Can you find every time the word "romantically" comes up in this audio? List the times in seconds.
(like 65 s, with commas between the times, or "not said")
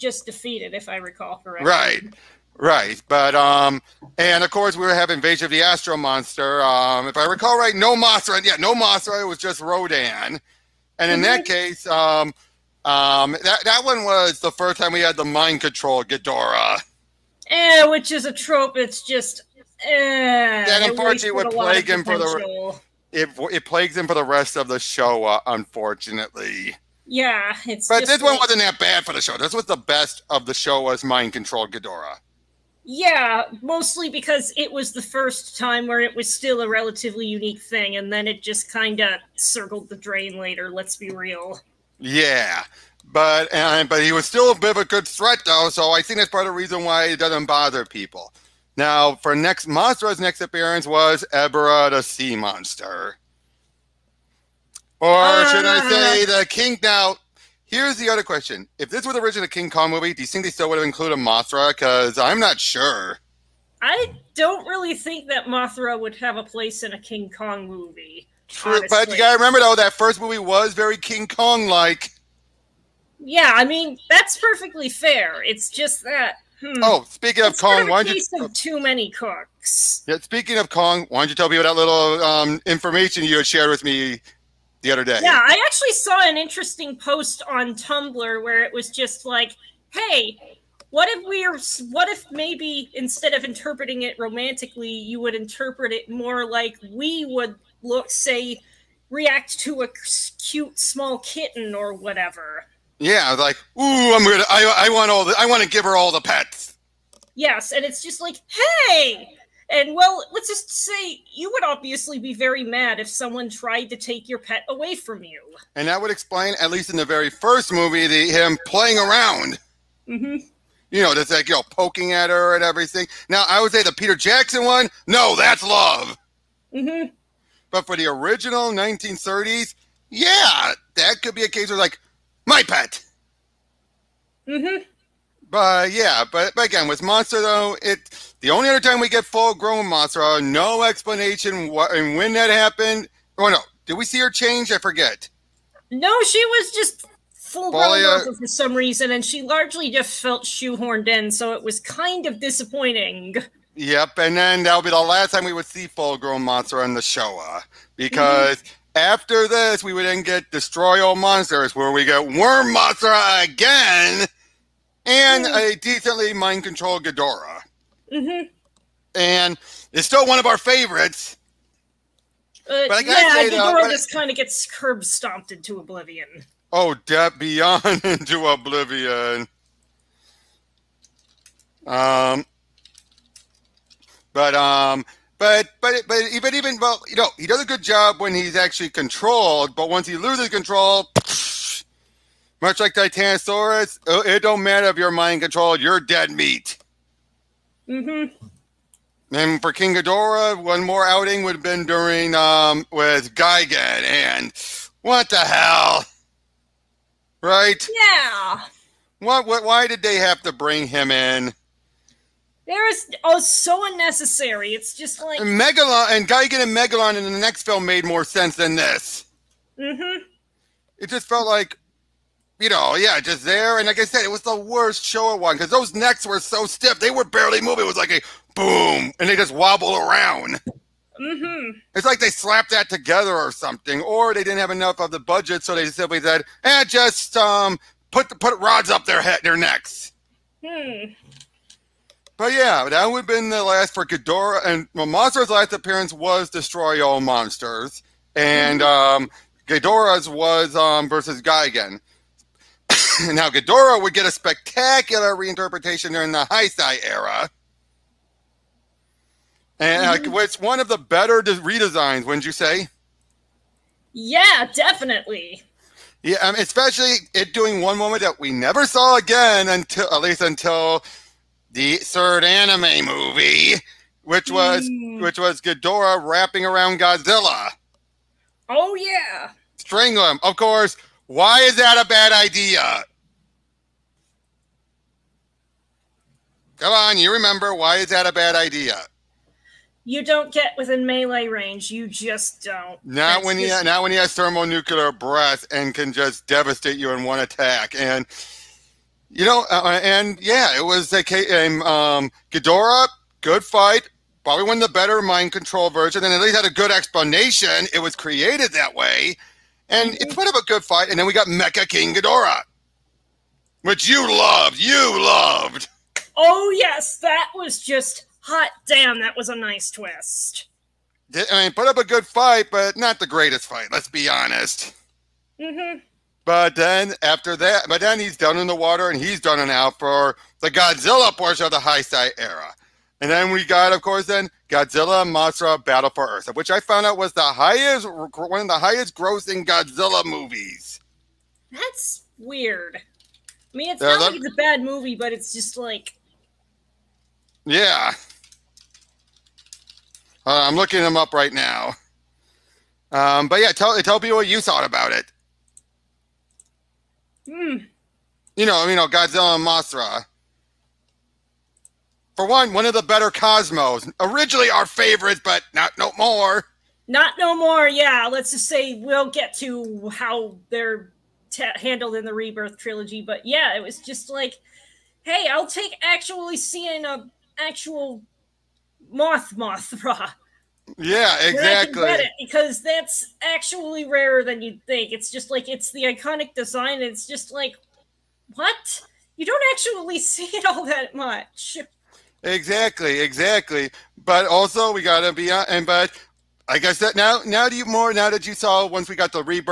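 94 s.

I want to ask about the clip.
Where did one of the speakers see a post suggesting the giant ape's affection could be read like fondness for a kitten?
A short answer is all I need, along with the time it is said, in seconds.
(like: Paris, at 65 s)
Tumblr, at 87 s.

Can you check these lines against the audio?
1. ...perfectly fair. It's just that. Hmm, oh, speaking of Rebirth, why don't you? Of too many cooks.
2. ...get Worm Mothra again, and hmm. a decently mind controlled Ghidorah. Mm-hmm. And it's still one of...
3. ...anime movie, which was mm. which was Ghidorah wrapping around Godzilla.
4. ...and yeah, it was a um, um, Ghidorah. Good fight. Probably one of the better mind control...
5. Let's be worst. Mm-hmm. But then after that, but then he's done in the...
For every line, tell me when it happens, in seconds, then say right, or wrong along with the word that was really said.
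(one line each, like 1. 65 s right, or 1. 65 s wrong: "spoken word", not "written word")
1. 74 s wrong: "Kong", not "Rebirth"
2. 162 s right
3. 272 s right
4. 300 s right
5. 323 s wrong: "honest", not "worst".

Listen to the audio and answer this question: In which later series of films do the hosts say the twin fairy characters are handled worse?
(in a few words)
Rebirth trilogy.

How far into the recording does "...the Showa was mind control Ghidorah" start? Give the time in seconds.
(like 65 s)
30 s.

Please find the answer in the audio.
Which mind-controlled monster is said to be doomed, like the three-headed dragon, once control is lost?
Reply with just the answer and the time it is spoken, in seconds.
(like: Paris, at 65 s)
Titanosaurus, at 192 s.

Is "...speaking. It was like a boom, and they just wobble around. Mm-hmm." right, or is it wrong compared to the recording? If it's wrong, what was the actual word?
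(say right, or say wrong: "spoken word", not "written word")
wrong: "moving", not "speaking".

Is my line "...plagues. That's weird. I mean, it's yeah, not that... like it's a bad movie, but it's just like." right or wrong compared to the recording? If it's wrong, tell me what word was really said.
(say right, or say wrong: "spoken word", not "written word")
wrong: "movies", not "plagues".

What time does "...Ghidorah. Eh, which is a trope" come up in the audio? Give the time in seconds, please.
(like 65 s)
16 s.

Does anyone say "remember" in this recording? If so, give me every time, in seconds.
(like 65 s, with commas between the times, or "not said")
69 s, 287 s.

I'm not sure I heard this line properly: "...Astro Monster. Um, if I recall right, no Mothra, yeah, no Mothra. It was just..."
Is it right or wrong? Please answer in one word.
right.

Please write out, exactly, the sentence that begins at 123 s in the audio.
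Now, I would say the Peter Jackson one, no, that's love.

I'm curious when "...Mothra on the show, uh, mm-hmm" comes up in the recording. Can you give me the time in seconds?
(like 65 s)
156 s.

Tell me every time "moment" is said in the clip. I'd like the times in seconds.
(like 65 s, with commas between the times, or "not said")
267 s.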